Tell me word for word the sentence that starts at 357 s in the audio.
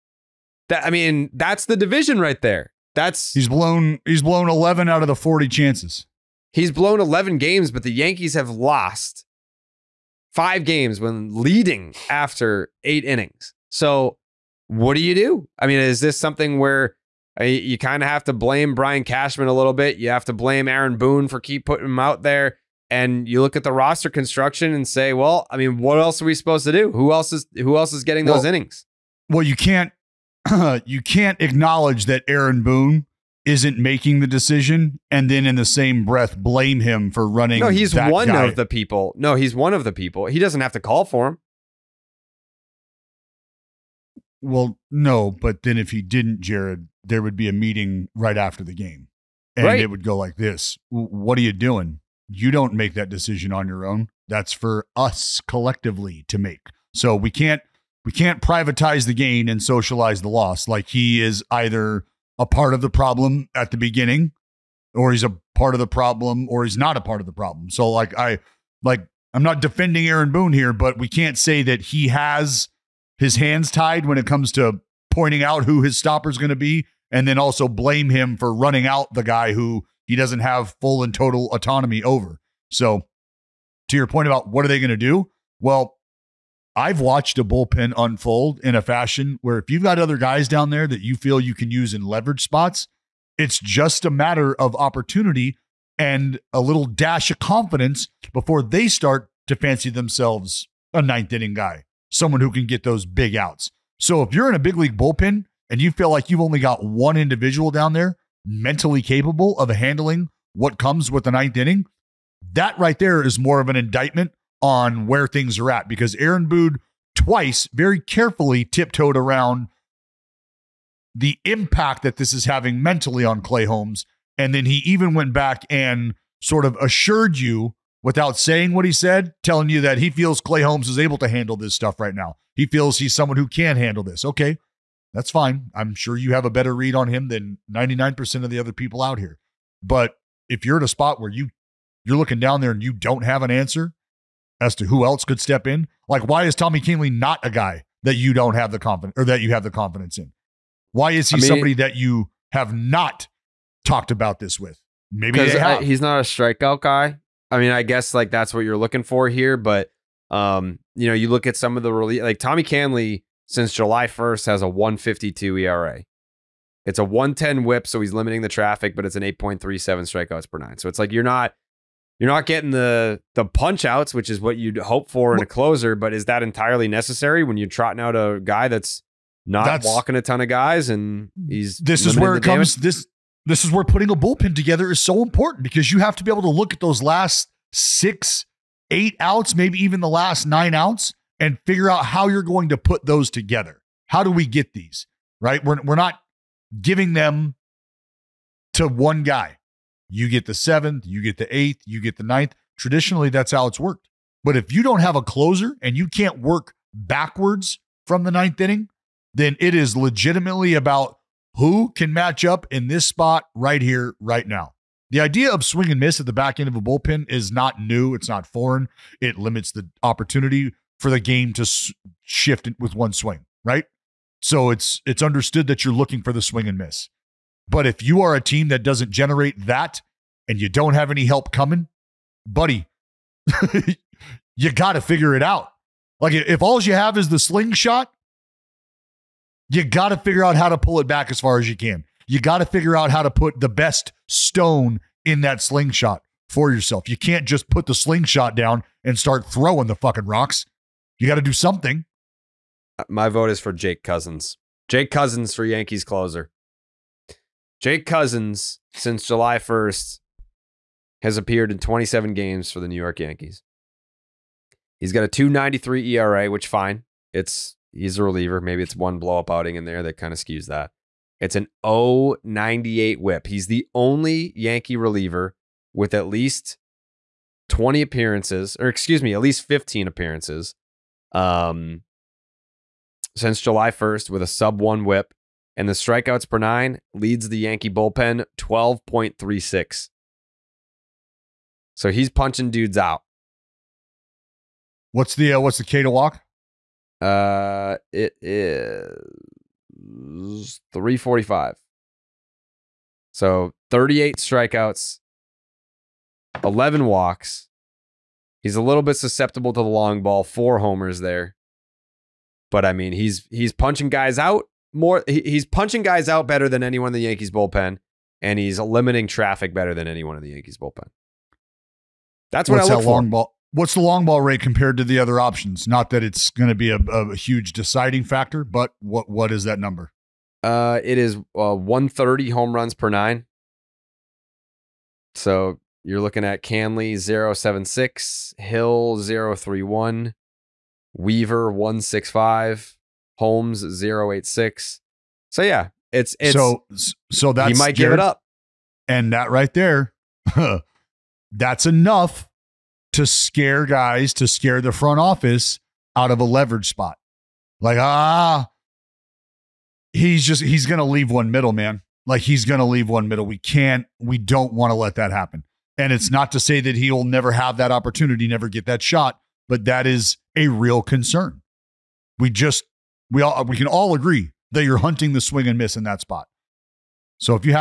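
Like, ah, he's just he's gonna leave one middle, man.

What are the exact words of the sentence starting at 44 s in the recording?
Well, no, but then if he didn't, Jared, there would be a meeting right after the game.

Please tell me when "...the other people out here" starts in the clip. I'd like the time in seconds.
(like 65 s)
138 s.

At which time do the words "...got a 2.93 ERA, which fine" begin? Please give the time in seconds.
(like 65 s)
265 s.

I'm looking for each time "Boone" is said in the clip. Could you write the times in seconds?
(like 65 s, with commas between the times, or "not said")
20 s, 32 s, 70 s, 116 s.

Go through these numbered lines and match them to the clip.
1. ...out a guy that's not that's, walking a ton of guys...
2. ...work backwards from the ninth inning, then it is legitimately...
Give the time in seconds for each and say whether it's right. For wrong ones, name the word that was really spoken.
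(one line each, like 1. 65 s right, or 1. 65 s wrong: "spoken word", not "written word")
1. 178 s right
2. 206 s right.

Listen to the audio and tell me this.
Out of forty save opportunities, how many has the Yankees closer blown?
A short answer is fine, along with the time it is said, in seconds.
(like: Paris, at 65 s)
11, at 4 s.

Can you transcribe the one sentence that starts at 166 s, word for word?
It's a 110 whip, so he's limiting the traffic, but it's an 8.37 strikeouts per nine.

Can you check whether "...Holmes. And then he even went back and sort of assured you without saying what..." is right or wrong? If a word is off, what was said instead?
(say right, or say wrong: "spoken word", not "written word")
right.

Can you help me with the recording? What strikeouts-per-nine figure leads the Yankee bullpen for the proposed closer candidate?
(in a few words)
12.36.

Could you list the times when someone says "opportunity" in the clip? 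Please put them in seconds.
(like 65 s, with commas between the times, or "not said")
94 s, 220 s, 367 s.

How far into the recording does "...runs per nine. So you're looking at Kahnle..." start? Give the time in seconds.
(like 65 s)
332 s.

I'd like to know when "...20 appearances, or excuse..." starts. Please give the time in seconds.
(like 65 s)
277 s.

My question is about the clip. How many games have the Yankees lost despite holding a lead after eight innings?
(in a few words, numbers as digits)
5.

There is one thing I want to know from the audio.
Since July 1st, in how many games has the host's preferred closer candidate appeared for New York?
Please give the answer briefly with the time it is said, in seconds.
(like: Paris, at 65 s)
27, at 261 s.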